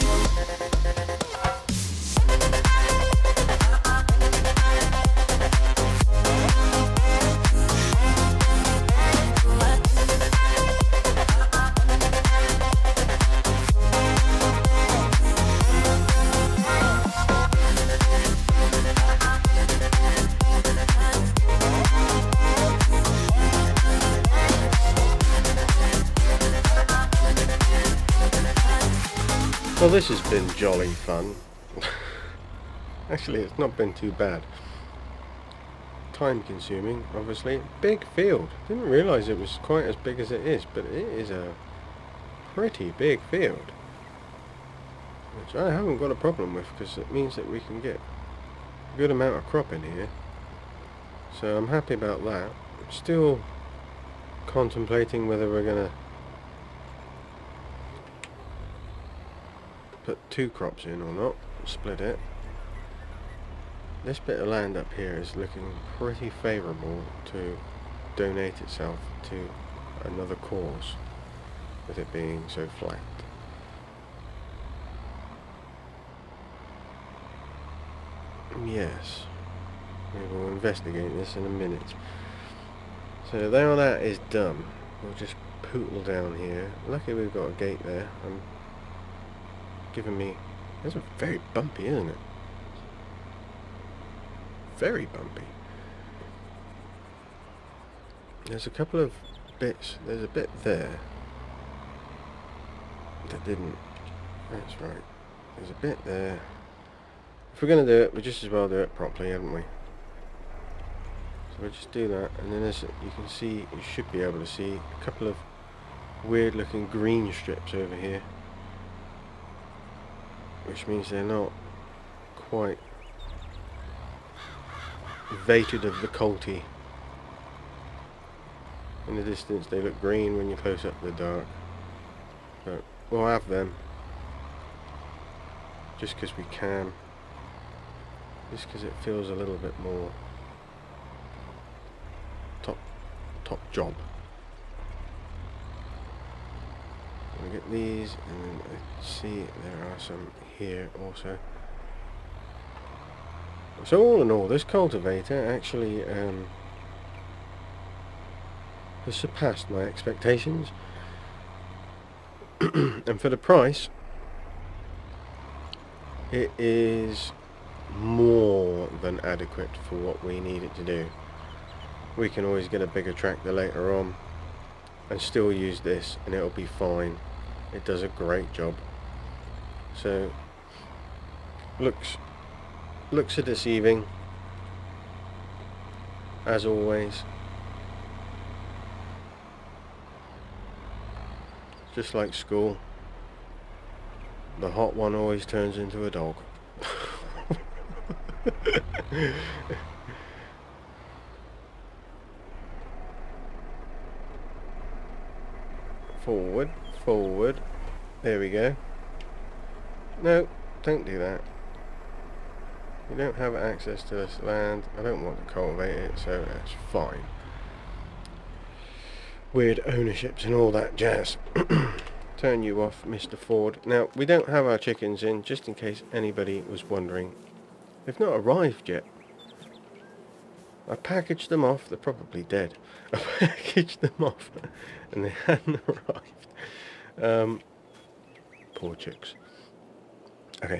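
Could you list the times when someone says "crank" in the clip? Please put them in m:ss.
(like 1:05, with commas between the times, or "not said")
not said.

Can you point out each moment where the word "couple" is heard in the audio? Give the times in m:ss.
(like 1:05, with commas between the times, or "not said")
1:38, 1:55.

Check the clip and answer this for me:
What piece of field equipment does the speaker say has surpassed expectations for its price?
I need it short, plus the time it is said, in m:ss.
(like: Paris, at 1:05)
Cultivator, at 2:34.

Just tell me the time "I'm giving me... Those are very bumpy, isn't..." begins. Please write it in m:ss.
1:28.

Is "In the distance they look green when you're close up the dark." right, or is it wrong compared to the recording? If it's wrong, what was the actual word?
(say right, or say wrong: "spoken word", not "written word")
right.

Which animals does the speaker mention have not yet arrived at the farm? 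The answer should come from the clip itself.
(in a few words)
Chickens.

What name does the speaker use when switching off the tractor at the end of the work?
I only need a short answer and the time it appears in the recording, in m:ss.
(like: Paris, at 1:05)
Mr. Ford, at 3:43.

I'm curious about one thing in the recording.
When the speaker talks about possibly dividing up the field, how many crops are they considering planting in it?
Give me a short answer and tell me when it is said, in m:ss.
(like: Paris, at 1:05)
2, at 1:00.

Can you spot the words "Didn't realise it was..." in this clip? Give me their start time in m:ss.
0:38.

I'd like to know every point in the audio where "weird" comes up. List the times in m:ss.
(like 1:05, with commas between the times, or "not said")
1:56, 3:39.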